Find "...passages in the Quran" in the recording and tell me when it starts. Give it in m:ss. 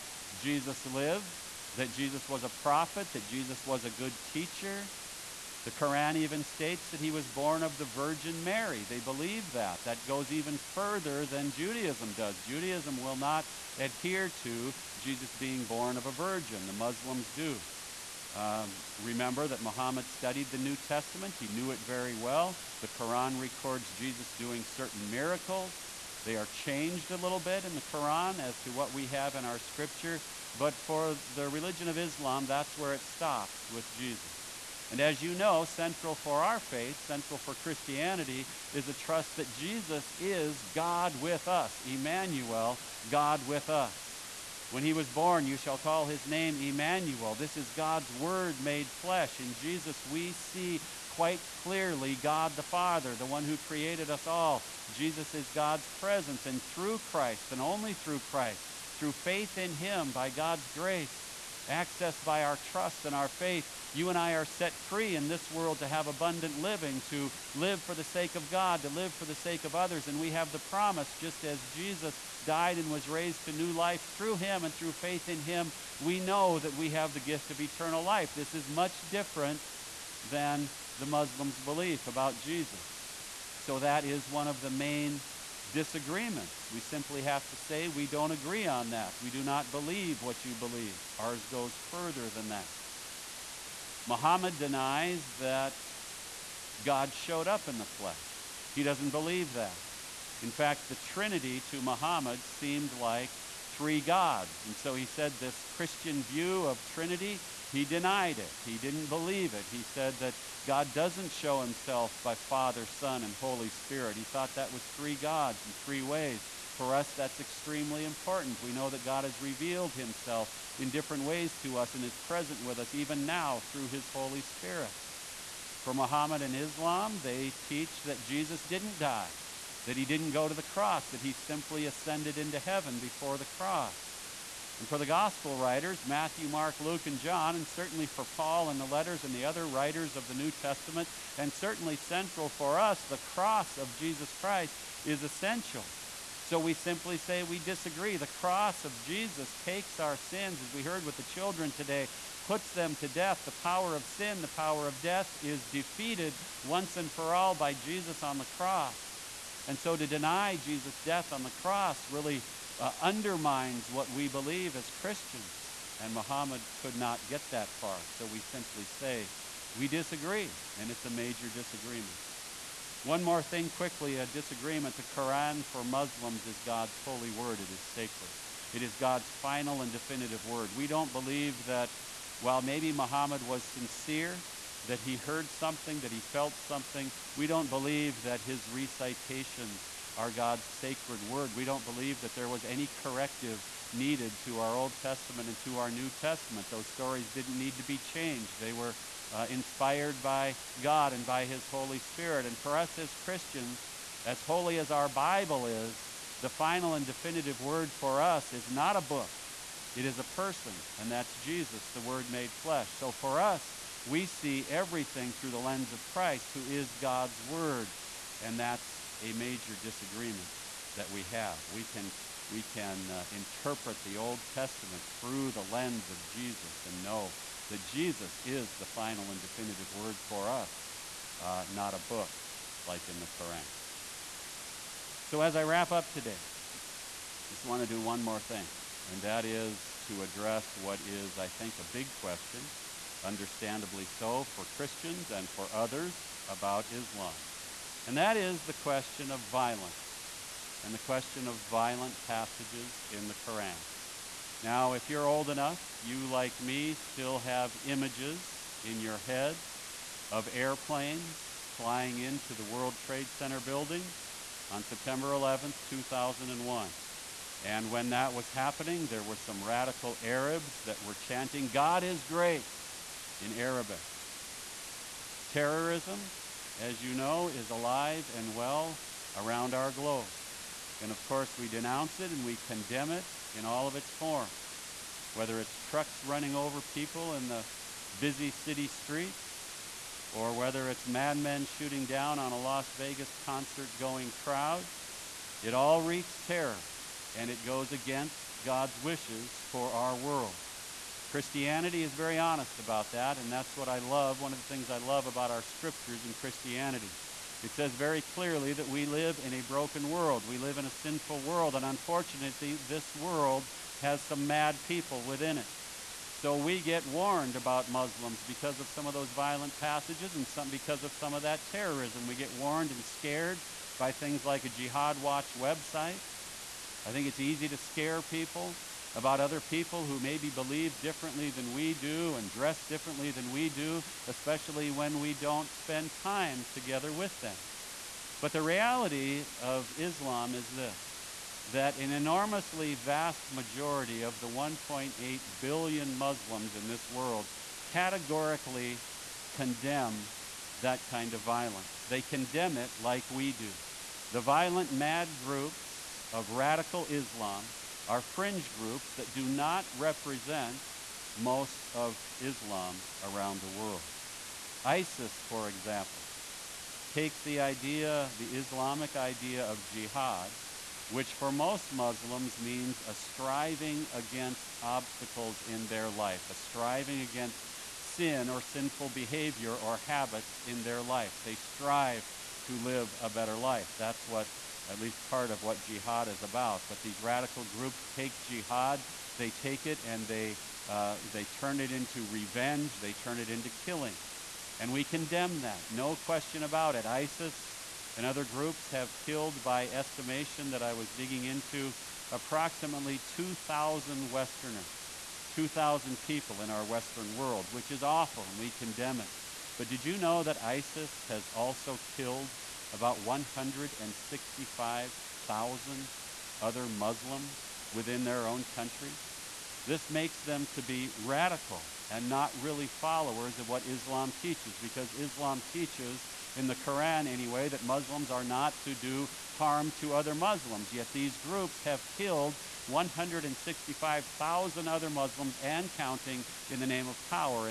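4:12.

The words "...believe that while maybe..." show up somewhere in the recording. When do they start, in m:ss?
3:01.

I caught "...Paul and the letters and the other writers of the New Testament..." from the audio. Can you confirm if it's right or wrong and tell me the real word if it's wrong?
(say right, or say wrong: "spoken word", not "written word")
right.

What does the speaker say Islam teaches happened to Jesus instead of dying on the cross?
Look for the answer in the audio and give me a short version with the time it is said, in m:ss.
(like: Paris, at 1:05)
ascended into heaven, at 2:11.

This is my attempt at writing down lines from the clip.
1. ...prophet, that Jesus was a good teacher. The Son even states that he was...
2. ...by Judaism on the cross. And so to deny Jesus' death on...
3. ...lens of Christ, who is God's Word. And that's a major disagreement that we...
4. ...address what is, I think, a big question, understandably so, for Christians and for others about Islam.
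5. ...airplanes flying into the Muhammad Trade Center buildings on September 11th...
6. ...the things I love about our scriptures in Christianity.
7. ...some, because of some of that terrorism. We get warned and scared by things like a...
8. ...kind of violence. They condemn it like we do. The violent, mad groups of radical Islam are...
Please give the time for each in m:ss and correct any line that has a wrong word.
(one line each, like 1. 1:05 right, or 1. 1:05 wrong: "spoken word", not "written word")
1. 0:02 wrong: "Quran", not "Son"
2. 2:37 wrong: "Jesus", not "Judaism"
3. 3:35 right
4. 4:00 right
5. 4:20 wrong: "World", not "Muhammad"
6. 5:04 right
7. 5:20 right
8. 5:51 right.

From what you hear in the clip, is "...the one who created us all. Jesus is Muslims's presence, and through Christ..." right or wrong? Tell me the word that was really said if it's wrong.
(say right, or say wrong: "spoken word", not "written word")
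wrong: "God", not "Muslims".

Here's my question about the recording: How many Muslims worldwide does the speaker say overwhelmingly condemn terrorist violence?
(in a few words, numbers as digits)
1.8 billion.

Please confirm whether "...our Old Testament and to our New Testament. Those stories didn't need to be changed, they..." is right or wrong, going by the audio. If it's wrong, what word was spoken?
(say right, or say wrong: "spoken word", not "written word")
right.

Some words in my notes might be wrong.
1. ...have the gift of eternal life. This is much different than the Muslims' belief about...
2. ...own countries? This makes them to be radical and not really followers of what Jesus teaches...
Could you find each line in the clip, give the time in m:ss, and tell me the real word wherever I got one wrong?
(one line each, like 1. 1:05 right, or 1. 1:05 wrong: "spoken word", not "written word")
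1. 1:16 right
2. 6:58 wrong: "Islam", not "Jesus".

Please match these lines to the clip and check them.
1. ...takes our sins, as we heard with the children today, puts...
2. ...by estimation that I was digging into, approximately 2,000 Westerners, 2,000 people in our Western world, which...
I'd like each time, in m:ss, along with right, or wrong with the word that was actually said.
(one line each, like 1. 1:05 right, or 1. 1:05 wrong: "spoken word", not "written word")
1. 2:29 right
2. 6:39 right.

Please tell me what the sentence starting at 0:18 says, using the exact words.
Um, remember that Muhammad studied the New Testament, he knew it very well.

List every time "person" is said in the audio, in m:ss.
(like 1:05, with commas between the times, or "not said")
3:30.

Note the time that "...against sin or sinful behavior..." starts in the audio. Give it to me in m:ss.
6:17.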